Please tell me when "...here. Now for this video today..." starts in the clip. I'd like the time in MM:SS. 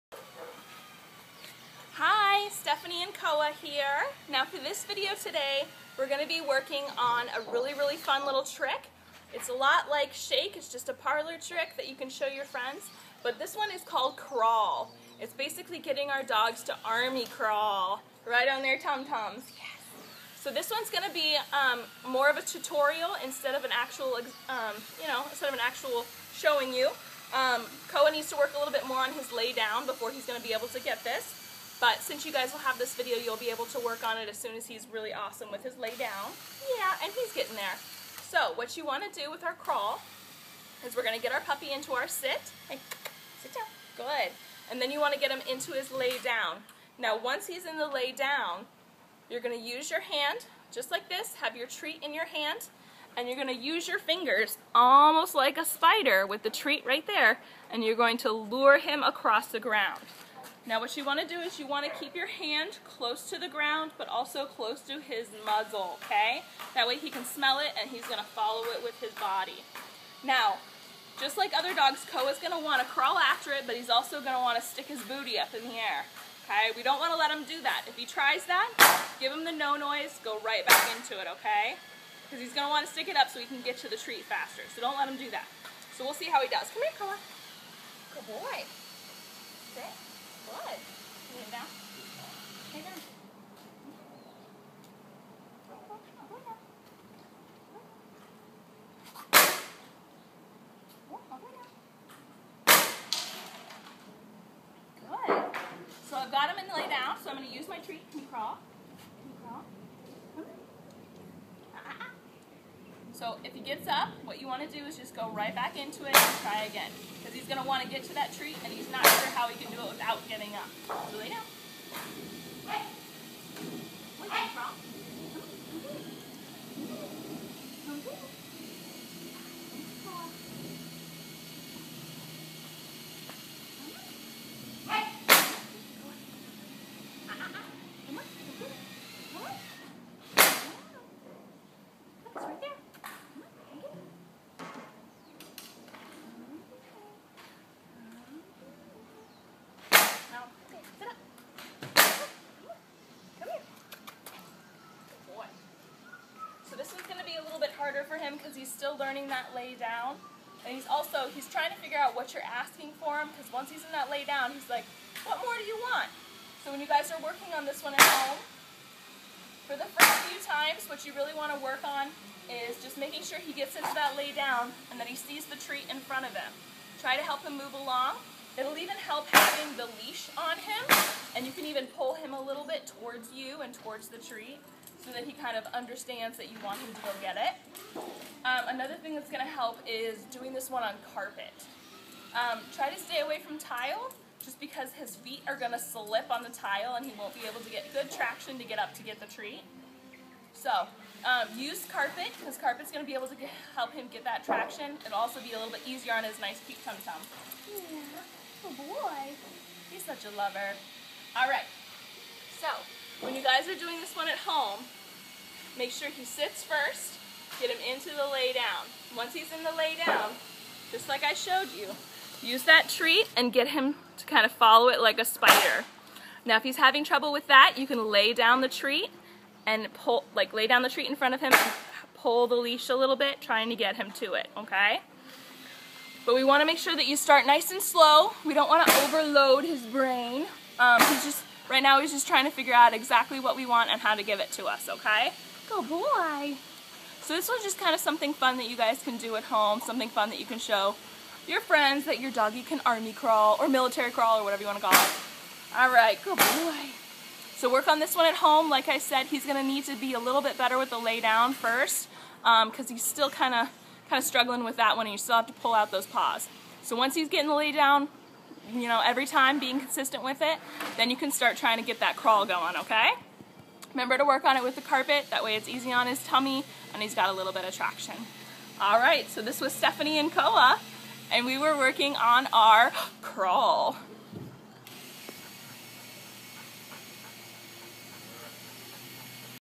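00:03.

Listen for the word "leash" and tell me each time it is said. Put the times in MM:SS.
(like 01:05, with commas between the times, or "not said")
03:00, 03:52.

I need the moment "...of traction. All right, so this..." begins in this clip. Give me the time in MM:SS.
04:37.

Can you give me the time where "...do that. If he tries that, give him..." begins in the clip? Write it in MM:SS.
01:17.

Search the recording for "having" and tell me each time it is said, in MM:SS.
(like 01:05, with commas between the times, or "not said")
02:59, 03:46.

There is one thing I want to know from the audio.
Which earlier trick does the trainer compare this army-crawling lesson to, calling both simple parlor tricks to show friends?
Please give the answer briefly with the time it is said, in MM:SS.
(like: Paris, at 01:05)
Shake, at 00:10.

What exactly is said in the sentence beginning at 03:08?
Um, another thing that's going to help is doing this one on carpet.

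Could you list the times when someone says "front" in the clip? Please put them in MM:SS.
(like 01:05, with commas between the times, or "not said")
02:56, 03:51.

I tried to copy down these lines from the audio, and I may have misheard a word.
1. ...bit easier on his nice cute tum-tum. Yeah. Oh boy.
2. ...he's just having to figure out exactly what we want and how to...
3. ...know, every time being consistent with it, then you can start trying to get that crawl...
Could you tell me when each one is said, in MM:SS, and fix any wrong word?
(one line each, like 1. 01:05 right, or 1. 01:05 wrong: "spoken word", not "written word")
1. 03:25 right
2. 04:02 wrong: "trying", not "having"
3. 04:28 right.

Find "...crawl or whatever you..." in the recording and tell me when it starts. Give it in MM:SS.
04:14.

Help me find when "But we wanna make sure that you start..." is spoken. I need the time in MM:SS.
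03:56.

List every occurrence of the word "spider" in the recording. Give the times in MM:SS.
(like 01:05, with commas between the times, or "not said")
00:55, 03:45.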